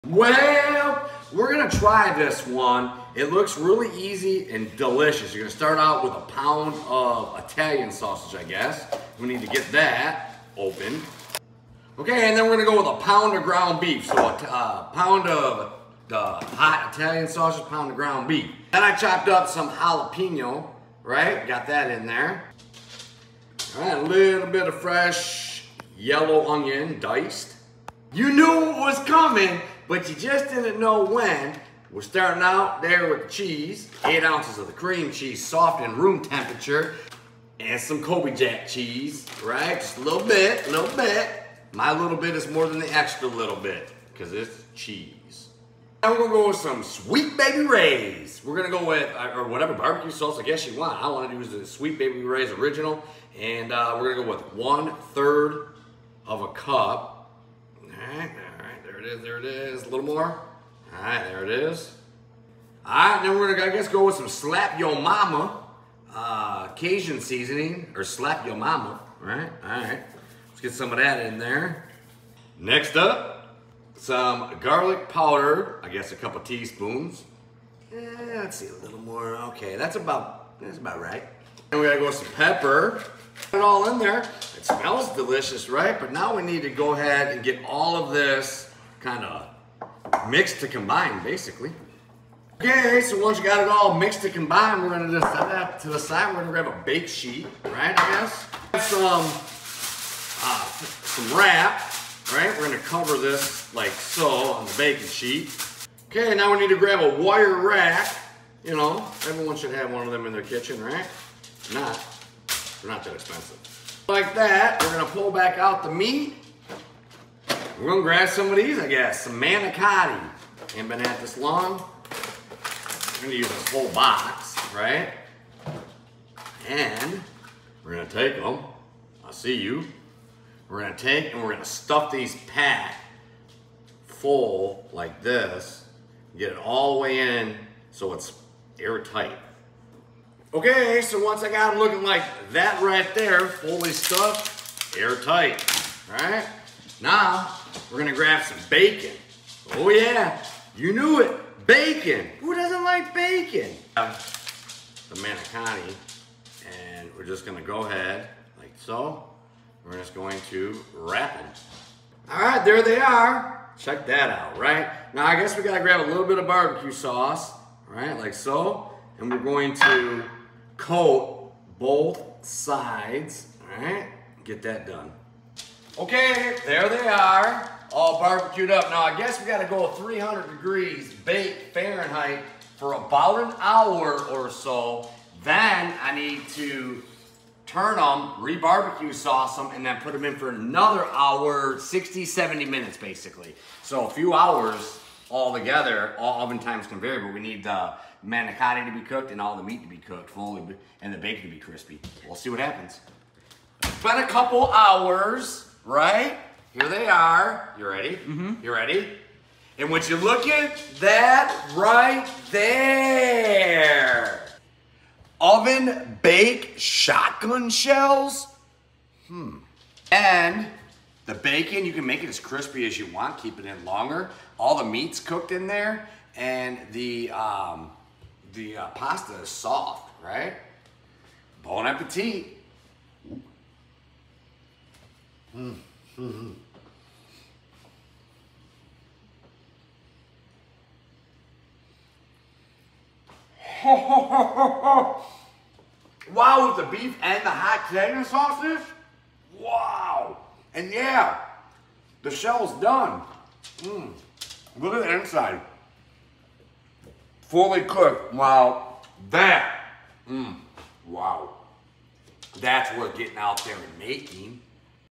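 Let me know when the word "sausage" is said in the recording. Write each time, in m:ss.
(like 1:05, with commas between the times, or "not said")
0:07, 0:17, 4:08.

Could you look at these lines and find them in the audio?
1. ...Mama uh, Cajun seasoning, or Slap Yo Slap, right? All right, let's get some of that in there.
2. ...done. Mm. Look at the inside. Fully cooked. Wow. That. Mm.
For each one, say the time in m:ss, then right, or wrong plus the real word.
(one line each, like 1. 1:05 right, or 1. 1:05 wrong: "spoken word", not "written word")
1. 1:04 wrong: "Mama", not "Slap"
2. 4:12 right.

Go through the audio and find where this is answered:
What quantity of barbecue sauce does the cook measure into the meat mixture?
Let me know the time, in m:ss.
0:54.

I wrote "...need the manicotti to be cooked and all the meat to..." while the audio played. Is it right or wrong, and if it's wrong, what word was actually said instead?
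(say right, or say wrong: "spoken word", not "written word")
right.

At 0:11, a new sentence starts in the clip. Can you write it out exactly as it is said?
Okay, and then we're gonna go with a pound of ground beef.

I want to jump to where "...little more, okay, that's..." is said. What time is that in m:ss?
1:18.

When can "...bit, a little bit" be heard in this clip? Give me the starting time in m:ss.
0:40.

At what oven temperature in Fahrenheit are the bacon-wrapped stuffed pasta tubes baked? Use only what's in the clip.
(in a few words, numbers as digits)
300 degrees.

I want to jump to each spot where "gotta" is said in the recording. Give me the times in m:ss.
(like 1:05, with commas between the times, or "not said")
1:21, 2:45, 2:59.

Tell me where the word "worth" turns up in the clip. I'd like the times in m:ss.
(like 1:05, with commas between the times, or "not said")
4:22.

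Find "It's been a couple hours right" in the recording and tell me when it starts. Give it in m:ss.
3:23.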